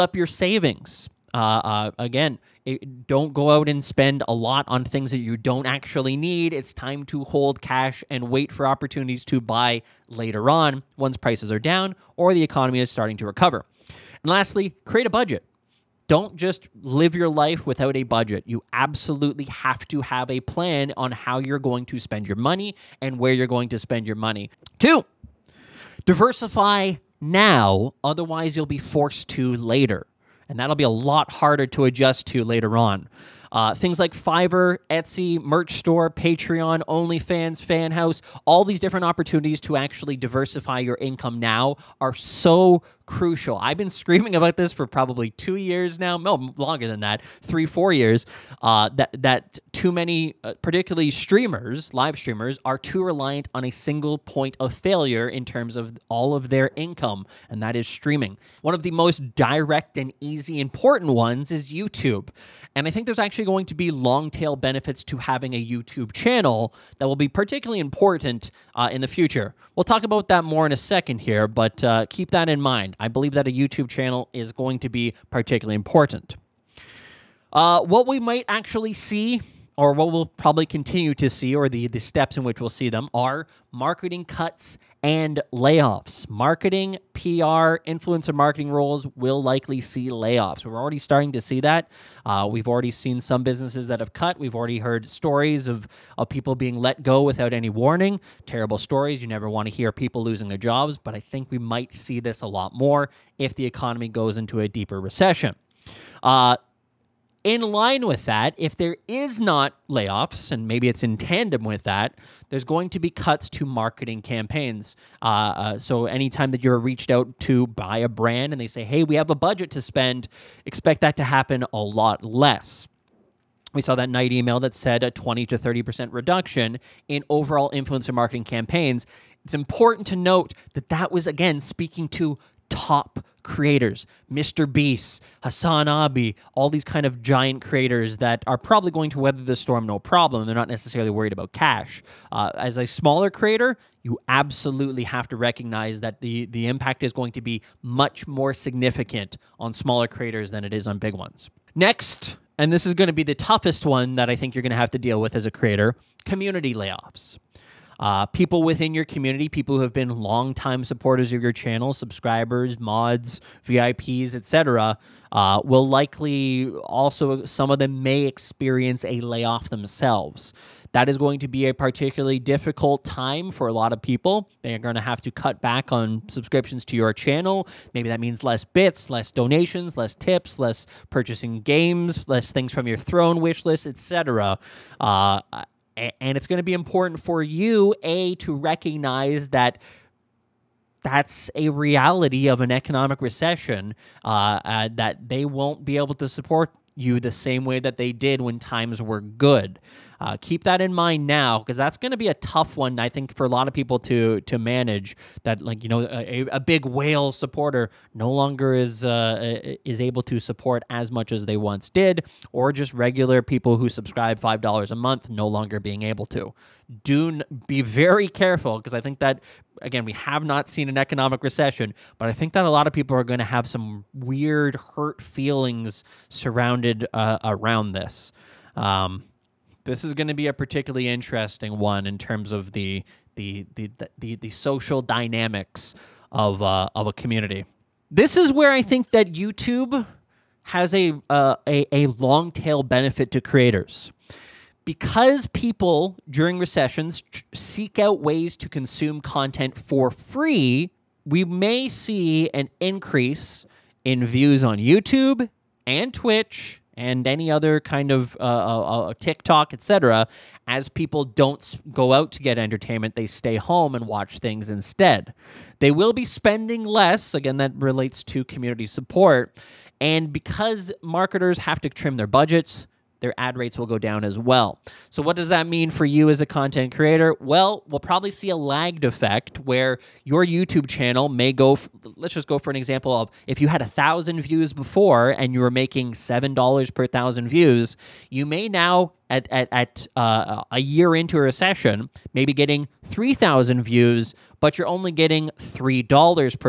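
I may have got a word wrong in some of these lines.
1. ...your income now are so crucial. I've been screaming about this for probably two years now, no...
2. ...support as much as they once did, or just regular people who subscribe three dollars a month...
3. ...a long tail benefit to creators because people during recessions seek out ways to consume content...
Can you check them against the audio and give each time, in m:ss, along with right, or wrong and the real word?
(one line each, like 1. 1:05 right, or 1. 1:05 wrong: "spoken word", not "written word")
1. 0:40 right
2. 3:30 wrong: "five", not "three"
3. 4:01 right.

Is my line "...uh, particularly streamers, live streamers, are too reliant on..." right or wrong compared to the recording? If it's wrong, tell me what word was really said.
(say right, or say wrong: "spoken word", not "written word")
right.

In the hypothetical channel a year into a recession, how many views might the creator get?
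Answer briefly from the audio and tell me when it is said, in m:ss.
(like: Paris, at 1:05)
3,000, at 4:53.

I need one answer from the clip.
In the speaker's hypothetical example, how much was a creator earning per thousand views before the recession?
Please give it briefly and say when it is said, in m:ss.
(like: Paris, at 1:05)
$7, at 4:46.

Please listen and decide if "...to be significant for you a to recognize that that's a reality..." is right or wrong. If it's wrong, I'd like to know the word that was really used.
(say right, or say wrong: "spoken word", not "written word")
wrong: "important", not "significant".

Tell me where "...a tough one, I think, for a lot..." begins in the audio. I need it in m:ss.
3:22.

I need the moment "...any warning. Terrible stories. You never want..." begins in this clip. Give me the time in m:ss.
1:37.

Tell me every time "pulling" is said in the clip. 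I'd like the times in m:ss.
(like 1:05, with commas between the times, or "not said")
not said.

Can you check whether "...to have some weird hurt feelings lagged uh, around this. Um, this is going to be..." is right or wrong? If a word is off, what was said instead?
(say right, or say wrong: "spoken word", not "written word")
wrong: "surrounded", not "lagged".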